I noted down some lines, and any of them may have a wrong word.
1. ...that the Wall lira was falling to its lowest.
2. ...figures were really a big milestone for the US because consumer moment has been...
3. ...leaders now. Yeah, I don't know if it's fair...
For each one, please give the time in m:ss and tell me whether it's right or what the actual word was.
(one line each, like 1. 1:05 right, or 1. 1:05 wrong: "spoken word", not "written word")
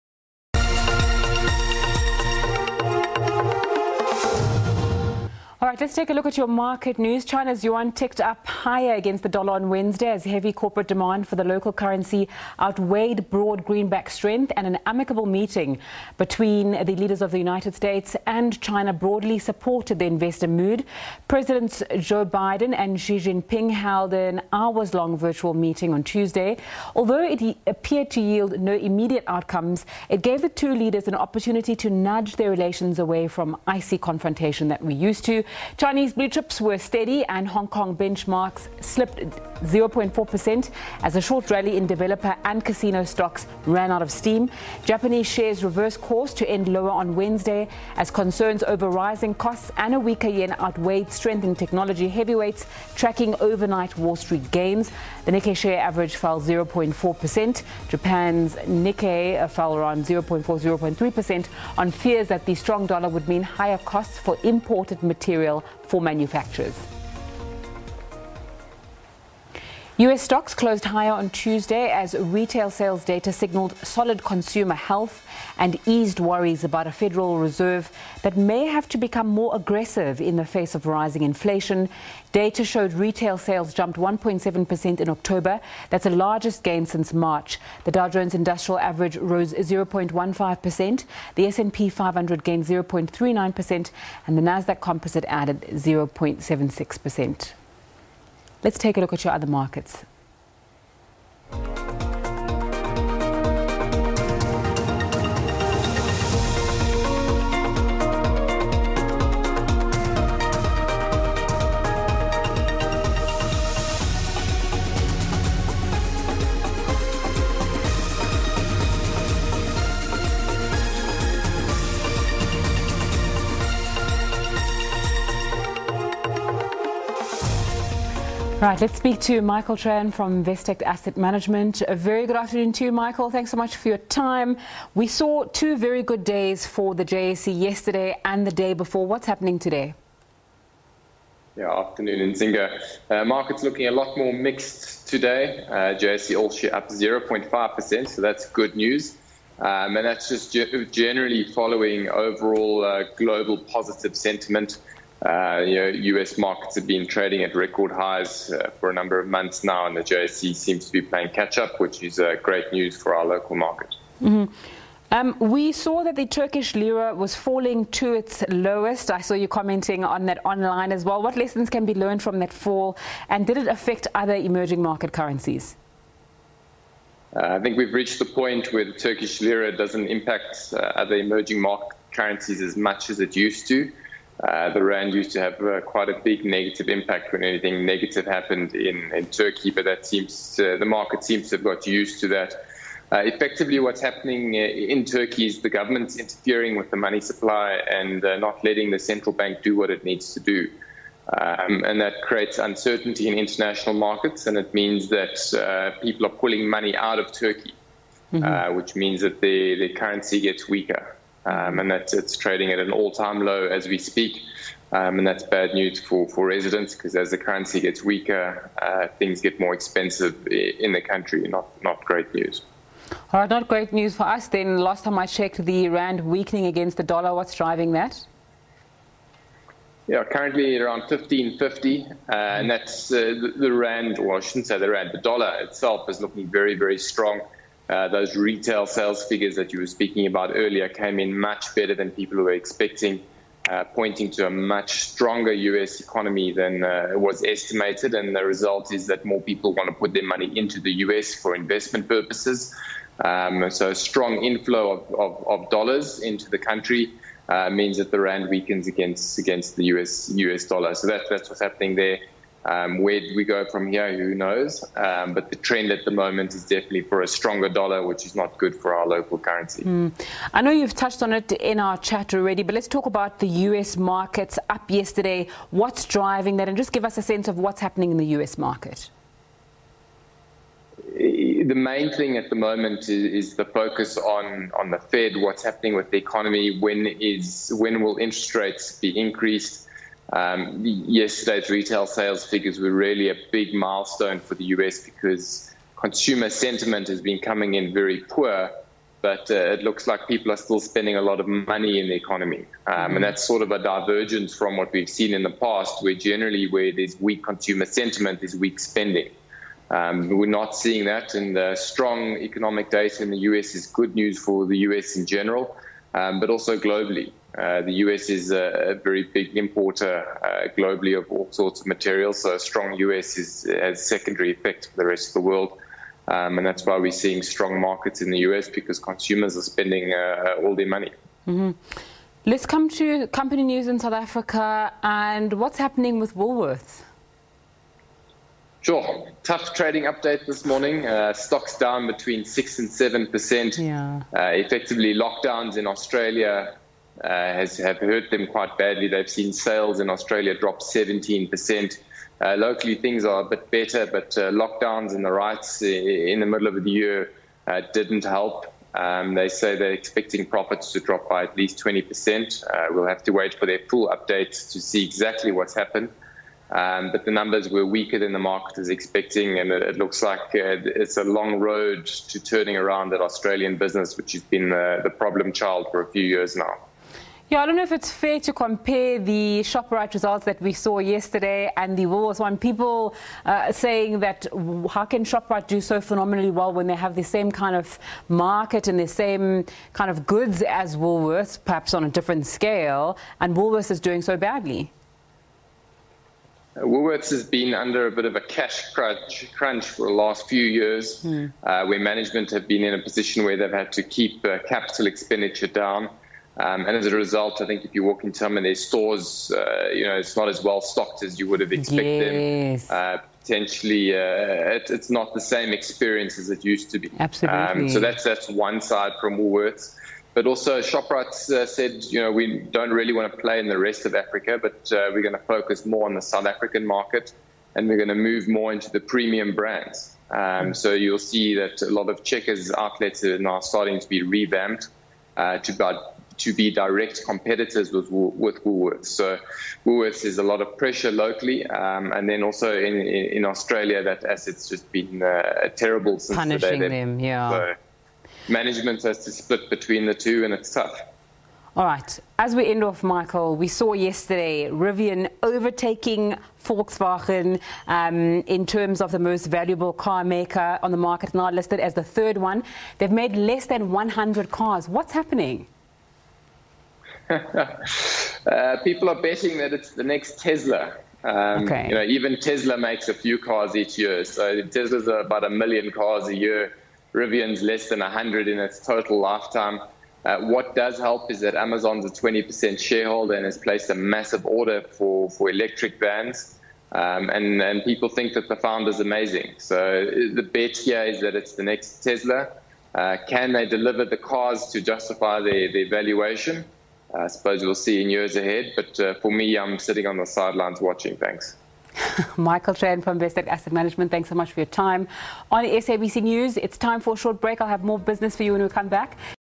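1. 2:46 wrong: "Turkish", not "Wall"
2. 4:52 wrong: "sentiment", not "moment"
3. 6:16 wrong: "years", not "leaders".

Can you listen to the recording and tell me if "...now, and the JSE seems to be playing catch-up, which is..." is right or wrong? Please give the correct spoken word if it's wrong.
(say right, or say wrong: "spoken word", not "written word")
right.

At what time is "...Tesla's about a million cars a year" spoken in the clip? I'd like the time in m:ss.
7:54.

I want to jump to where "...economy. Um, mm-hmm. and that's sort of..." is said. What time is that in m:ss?
5:02.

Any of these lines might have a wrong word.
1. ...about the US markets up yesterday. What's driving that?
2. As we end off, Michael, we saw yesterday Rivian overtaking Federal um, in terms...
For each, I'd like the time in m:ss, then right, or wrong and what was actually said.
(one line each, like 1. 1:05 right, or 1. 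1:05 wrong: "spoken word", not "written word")
1. 4:33 right
2. 7:32 wrong: "Volkswagen", not "Federal".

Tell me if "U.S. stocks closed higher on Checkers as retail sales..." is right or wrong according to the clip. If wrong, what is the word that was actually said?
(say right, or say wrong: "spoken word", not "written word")
wrong: "Tuesday", not "Checkers".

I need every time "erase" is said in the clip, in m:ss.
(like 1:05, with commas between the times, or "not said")
not said.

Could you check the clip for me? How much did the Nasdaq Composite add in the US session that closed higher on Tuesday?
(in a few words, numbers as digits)
0.76%.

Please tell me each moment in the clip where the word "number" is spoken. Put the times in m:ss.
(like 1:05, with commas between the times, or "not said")
2:38, 6:07.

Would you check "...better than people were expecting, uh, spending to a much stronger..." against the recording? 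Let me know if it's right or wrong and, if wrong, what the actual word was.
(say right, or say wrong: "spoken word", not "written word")
wrong: "pointing", not "spending".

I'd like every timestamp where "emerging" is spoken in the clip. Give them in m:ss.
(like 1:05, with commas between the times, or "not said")
2:54, 3:01.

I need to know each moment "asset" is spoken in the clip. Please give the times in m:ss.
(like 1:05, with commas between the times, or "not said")
2:10, 7:24, 8:23.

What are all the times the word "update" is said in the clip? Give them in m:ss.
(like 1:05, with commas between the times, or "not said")
5:40, 6:04.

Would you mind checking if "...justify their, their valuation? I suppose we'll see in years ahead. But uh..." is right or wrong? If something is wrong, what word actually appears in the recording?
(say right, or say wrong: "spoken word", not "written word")
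right.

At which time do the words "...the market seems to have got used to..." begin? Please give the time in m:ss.
3:10.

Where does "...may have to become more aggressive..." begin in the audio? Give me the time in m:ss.
1:18.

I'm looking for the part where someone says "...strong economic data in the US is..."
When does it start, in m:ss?
5:11.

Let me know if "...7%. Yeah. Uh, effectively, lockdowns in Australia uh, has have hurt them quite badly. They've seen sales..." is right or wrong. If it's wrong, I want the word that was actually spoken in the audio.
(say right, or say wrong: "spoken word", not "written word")
right.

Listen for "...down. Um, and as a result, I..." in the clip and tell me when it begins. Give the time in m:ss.
6:45.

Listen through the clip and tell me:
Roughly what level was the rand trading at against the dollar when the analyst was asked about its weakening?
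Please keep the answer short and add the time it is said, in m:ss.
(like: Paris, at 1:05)
15.50, at 3:51.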